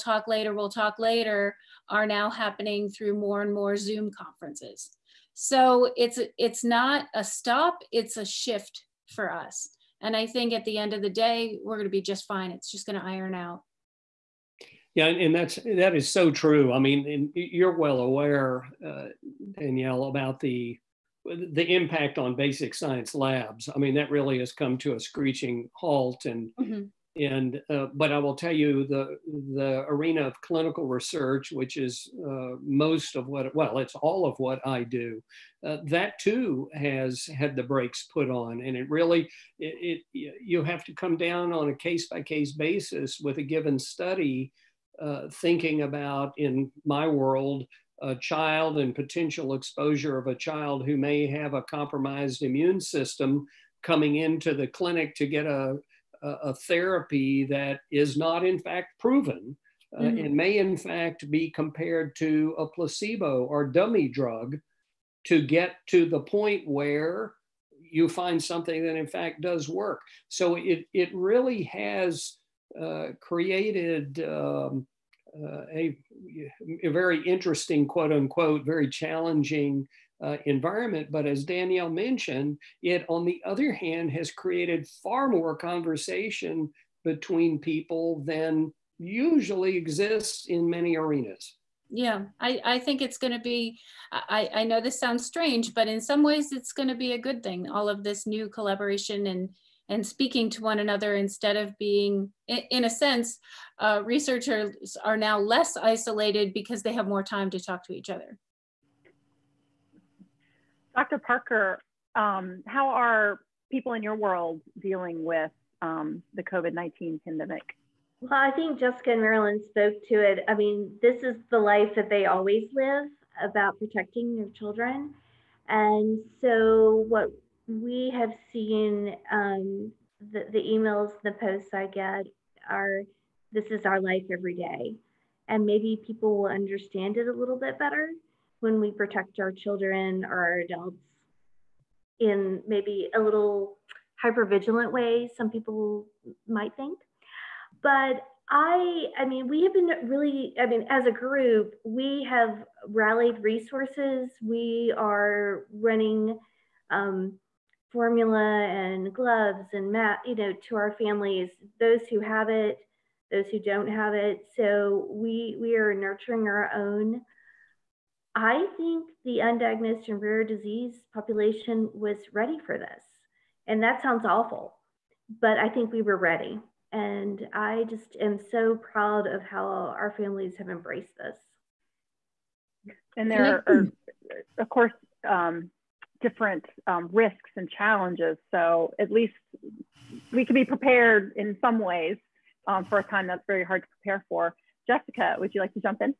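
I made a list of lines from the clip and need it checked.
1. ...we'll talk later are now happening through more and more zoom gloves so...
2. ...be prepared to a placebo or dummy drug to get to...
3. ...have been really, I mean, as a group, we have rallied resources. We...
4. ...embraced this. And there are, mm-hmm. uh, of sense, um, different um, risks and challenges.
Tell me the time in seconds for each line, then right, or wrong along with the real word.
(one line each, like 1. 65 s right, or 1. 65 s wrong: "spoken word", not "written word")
1. 0 s wrong: "conferences", not "gloves"
2. 61 s wrong: "compared", not "prepared"
3. 149 s right
4. 180 s wrong: "course", not "sense".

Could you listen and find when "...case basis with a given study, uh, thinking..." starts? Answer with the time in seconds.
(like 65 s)
42 s.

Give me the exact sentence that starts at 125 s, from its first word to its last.
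And so, what we have seen um, the, the emails, the posts I get are this is our life every day.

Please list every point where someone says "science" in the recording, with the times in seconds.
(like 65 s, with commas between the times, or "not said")
22 s.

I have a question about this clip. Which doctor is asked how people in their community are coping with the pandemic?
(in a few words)
Dr. Parker.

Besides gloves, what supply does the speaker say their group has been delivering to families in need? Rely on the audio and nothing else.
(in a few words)
formula.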